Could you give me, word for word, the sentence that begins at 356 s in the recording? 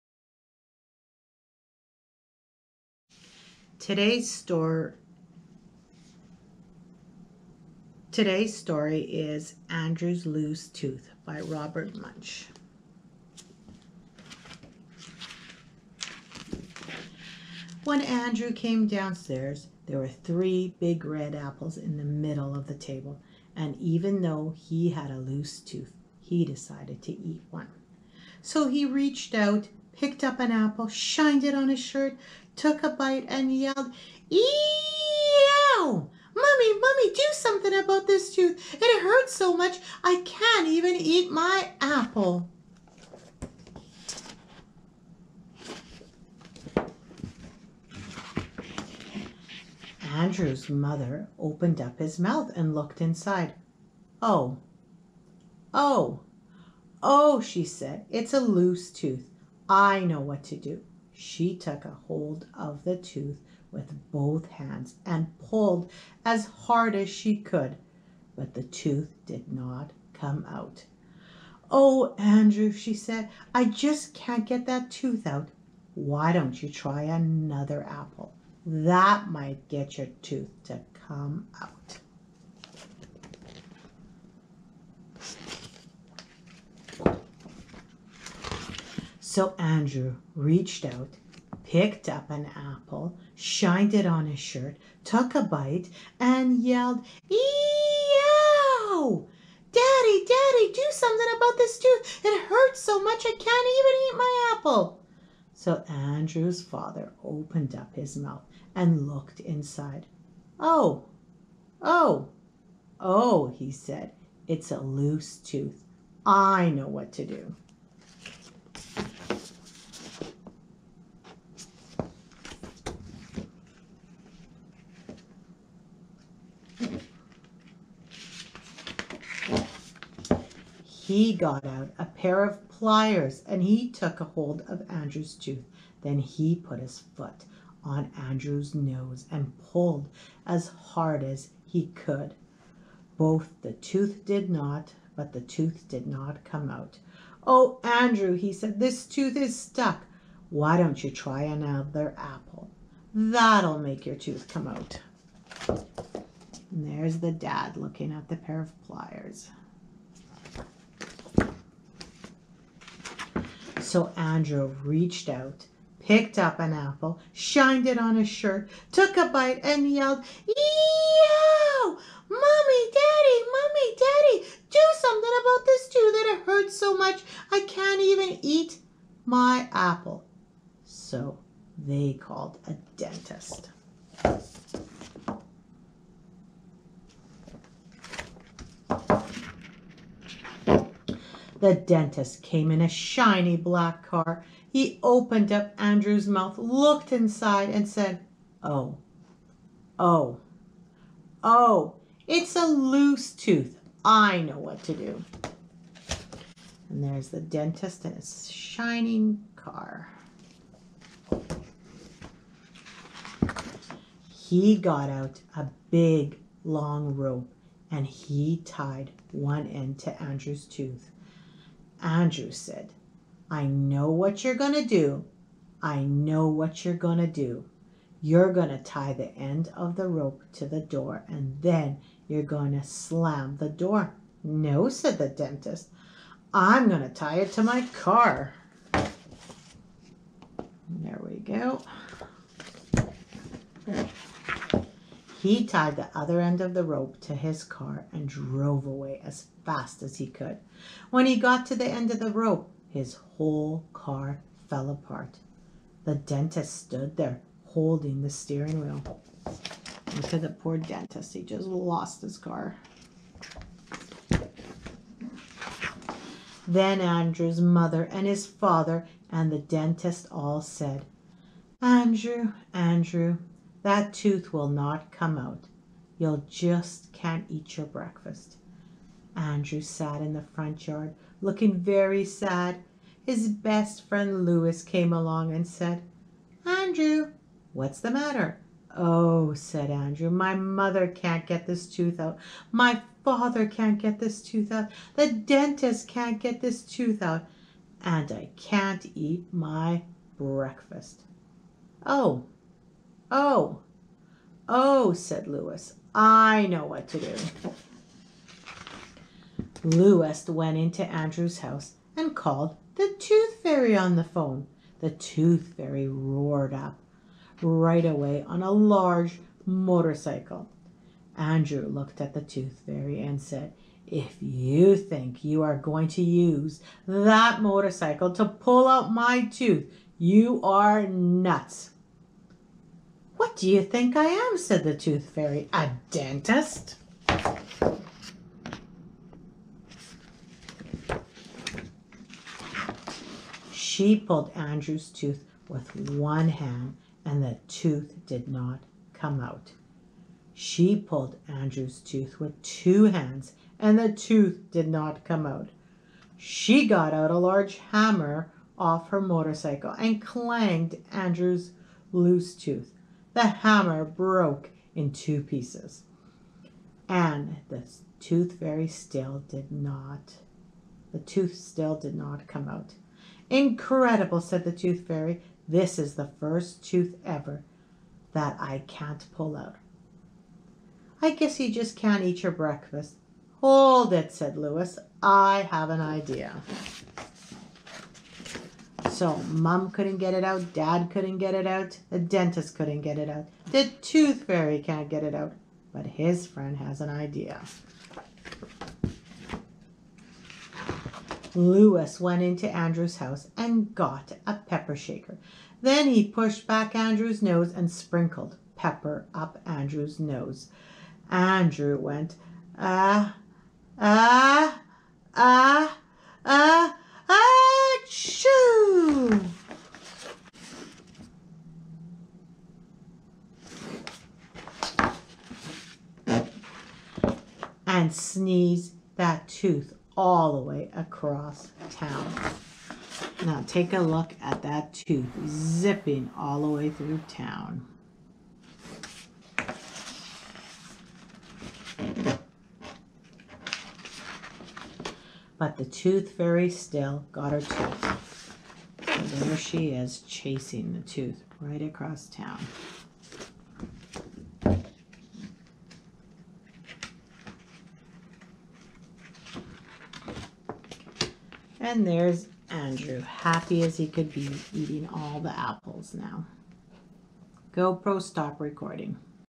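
She got out a large hammer off her motorcycle and clanged Andrew's loose tooth the hammer broke in two pieces.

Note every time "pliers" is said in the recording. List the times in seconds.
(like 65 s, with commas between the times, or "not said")
132 s, 158 s.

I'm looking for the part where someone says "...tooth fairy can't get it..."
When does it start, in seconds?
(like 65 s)
394 s.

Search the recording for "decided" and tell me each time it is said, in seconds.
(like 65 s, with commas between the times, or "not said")
26 s.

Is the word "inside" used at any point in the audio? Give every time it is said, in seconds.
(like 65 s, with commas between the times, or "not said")
53 s, 109 s, 197 s.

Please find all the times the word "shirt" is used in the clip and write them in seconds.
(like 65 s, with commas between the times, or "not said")
31 s, 94 s, 168 s.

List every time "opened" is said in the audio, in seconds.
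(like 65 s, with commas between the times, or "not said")
51 s, 107 s, 195 s.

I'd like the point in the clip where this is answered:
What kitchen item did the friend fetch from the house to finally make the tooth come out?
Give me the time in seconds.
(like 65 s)
404 s.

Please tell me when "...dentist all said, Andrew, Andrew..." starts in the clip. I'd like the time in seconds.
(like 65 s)
269 s.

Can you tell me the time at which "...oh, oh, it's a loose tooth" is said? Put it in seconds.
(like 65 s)
199 s.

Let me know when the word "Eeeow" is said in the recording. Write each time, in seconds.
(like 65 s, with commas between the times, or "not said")
97 s, 170 s.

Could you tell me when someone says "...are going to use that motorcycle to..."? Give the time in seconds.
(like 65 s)
325 s.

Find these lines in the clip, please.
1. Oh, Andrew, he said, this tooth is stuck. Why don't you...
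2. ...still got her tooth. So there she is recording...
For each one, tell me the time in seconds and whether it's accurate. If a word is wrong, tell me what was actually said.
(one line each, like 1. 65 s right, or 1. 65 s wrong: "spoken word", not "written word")
1. 147 s right
2. 446 s wrong: "chasing", not "recording".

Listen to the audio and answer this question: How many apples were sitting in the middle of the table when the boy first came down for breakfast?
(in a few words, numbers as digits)
3.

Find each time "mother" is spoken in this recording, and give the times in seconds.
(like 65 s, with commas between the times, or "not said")
50 s, 267 s, 290 s.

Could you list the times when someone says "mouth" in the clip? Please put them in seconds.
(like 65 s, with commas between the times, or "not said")
52 s, 108 s, 196 s.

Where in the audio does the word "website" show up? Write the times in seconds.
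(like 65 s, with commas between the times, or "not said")
not said.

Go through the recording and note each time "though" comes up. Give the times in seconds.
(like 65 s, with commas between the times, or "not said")
24 s.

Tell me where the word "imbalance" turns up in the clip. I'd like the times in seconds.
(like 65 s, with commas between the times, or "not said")
not said.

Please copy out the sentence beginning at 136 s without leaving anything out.
Then he put his foot on Andrew's nose and pulled as hard as he could.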